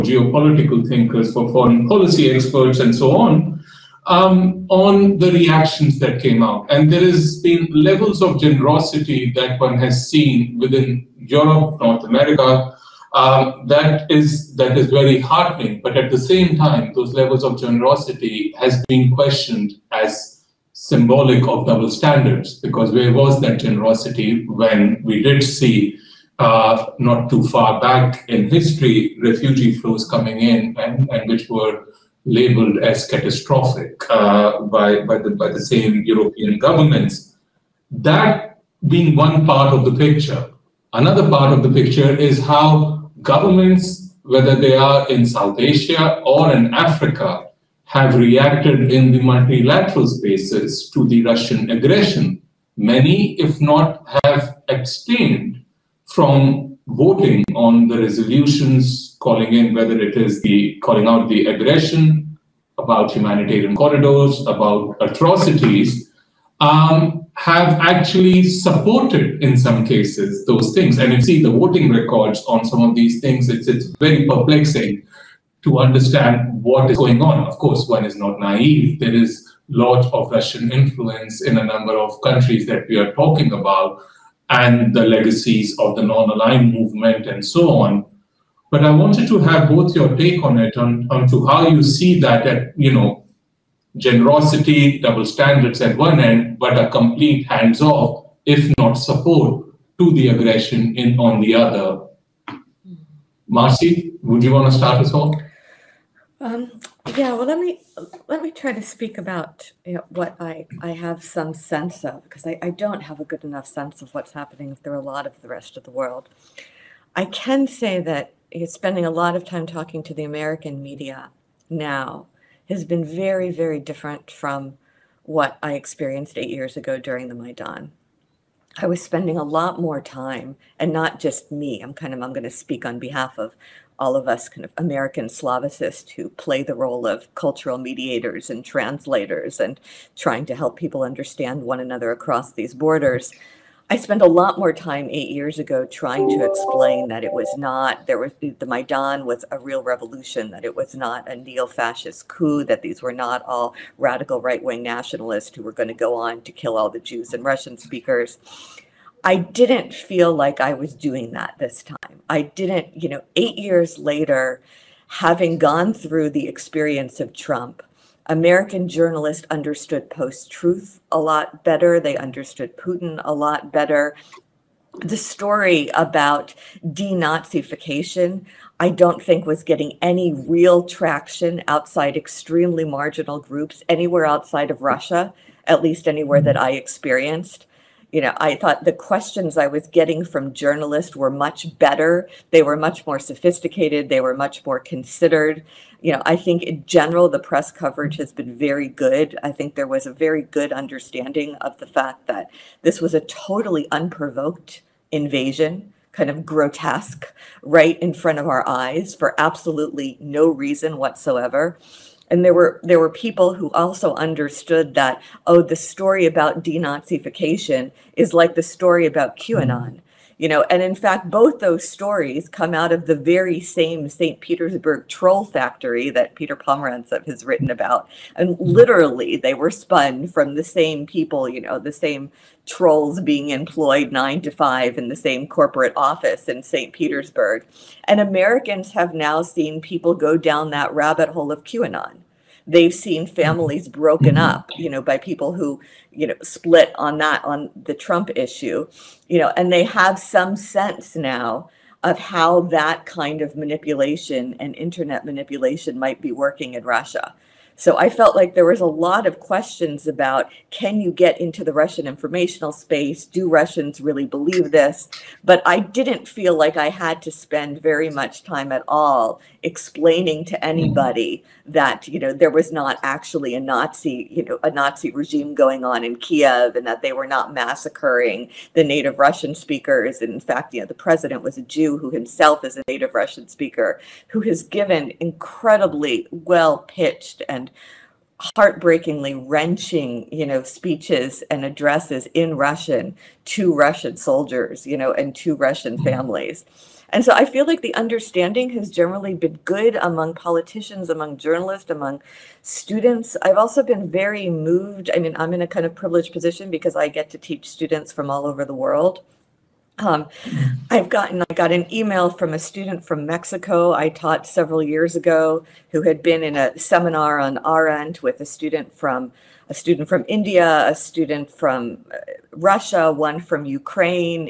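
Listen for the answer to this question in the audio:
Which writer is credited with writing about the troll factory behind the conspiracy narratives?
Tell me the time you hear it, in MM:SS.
03:46.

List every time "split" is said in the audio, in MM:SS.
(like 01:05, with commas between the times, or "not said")
04:06.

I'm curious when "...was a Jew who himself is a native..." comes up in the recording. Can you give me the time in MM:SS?
04:41.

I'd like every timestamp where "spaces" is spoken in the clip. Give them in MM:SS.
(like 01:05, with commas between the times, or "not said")
00:50, 04:22.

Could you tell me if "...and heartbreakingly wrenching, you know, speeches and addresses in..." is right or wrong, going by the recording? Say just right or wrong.
right.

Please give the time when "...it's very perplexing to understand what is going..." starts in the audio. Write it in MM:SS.
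01:13.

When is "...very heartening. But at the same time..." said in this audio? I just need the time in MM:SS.
00:14.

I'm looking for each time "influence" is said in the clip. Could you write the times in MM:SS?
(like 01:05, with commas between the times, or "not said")
01:20.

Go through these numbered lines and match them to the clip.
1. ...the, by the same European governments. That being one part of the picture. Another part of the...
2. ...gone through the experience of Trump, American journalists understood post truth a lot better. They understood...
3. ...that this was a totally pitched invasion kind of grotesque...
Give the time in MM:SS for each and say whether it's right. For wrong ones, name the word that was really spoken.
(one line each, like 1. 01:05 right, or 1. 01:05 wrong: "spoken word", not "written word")
1. 00:35 right
2. 02:45 right
3. 03:22 wrong: "unprovoked", not "pitched".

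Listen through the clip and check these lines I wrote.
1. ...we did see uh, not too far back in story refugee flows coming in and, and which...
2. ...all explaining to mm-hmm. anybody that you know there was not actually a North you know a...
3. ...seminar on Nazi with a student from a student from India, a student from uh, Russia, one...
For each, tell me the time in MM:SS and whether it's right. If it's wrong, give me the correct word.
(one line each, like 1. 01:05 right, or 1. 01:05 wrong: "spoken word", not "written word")
1. 00:25 wrong: "history", not "story"
2. 04:28 wrong: "Nazi", not "North"
3. 05:16 wrong: "Arendt", not "Nazi".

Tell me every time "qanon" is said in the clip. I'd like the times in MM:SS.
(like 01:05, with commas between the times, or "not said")
03:39, 04:01.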